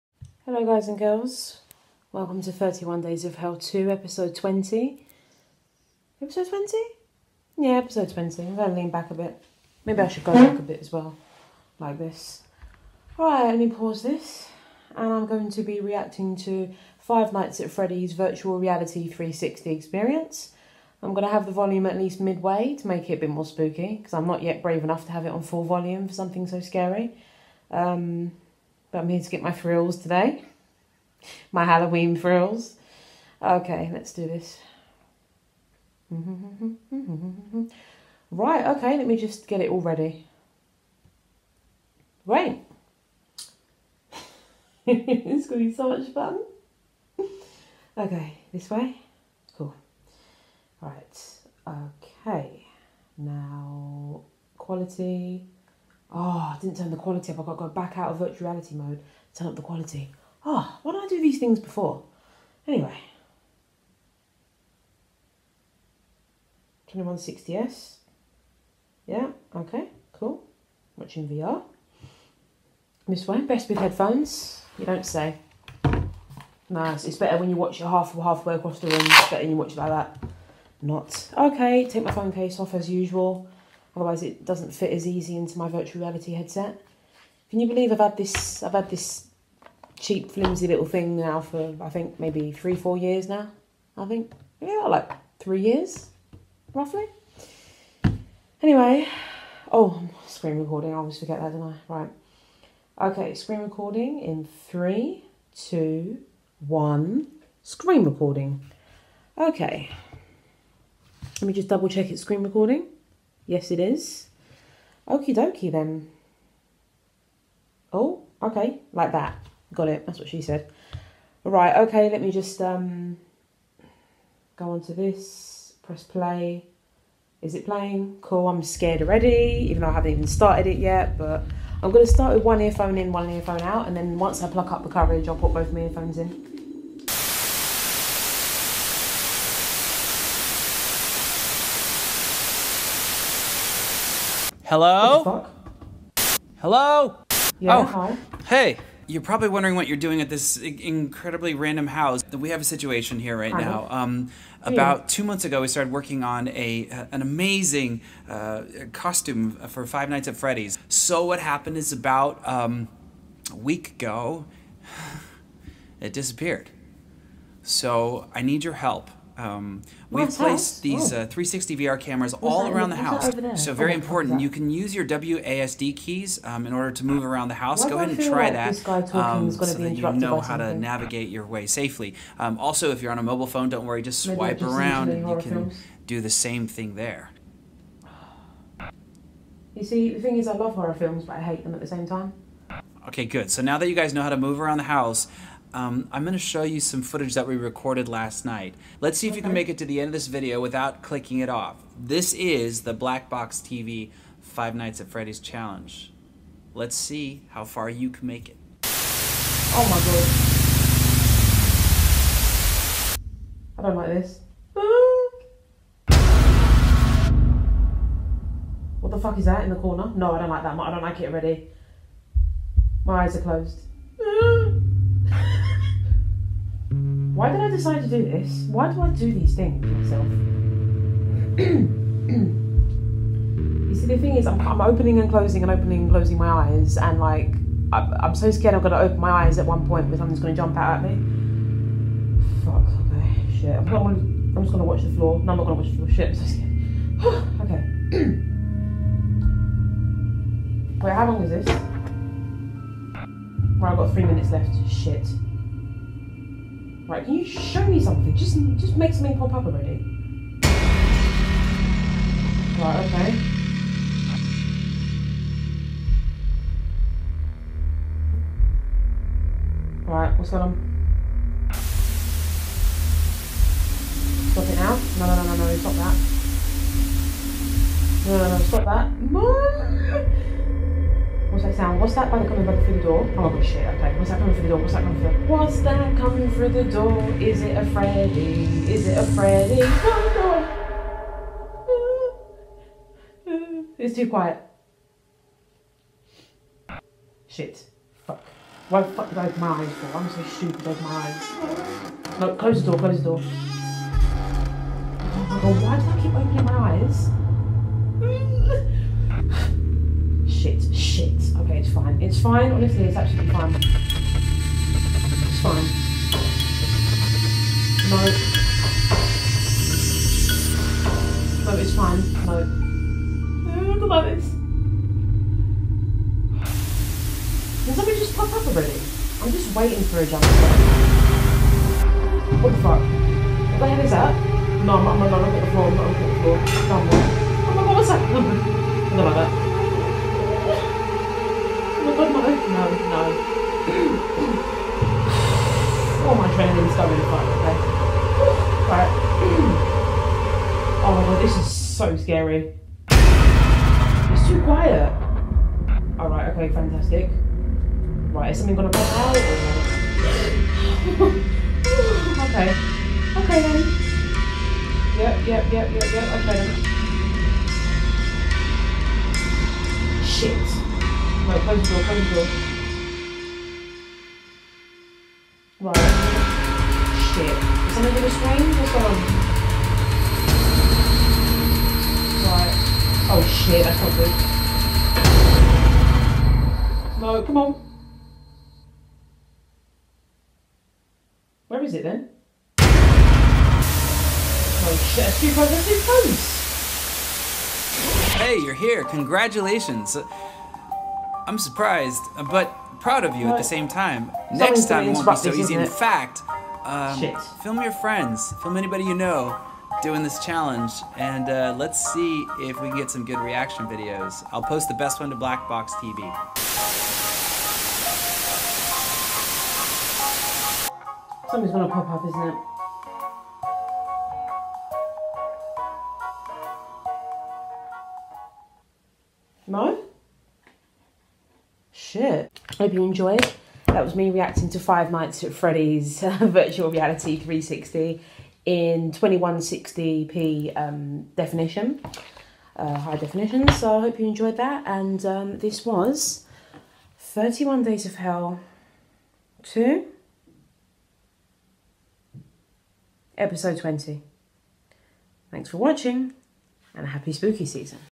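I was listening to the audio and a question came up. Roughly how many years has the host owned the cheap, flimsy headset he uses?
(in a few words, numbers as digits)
3.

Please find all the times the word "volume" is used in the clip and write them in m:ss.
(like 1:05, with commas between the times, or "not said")
0:21, 0:25.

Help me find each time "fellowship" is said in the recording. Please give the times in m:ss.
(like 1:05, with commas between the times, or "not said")
not said.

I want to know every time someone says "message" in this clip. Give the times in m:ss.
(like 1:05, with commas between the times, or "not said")
not said.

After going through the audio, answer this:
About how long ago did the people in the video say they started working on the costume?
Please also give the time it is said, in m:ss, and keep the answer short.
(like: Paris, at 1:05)
two months, at 2:35.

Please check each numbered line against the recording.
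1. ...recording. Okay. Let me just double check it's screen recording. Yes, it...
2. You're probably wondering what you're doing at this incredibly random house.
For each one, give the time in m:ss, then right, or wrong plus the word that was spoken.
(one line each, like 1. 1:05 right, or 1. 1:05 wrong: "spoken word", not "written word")
1. 1:48 right
2. 2:29 right.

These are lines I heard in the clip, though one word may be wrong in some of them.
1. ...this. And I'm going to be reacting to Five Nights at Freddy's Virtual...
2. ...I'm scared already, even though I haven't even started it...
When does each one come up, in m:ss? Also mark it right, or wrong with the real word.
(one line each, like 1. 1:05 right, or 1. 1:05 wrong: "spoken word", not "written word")
1. 0:14 right
2. 2:08 right.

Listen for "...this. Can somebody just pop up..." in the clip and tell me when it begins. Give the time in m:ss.
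5:24.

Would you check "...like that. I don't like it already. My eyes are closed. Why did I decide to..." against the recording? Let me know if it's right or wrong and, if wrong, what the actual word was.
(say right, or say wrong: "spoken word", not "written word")
right.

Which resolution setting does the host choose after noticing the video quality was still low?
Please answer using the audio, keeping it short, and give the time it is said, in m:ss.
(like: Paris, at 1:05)
2160S, at 1:06.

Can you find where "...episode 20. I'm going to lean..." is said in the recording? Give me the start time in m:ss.
0:07.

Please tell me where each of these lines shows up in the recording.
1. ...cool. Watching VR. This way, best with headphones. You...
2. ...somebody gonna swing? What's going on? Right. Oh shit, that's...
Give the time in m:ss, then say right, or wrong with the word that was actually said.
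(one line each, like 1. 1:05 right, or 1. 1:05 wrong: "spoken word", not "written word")
1. 1:10 right
2. 6:17 right.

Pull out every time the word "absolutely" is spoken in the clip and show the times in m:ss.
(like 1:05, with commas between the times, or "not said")
5:13.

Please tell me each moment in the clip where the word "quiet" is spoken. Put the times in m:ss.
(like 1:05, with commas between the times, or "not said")
4:54, 5:54.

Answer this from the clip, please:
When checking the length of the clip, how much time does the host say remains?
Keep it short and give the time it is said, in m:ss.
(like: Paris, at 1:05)
3 minutes, at 4:14.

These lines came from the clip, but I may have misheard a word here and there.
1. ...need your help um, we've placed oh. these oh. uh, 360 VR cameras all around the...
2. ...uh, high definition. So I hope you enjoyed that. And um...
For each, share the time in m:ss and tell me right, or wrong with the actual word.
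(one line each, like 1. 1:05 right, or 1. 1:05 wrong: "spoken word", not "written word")
1. 2:48 right
2. 7:22 right.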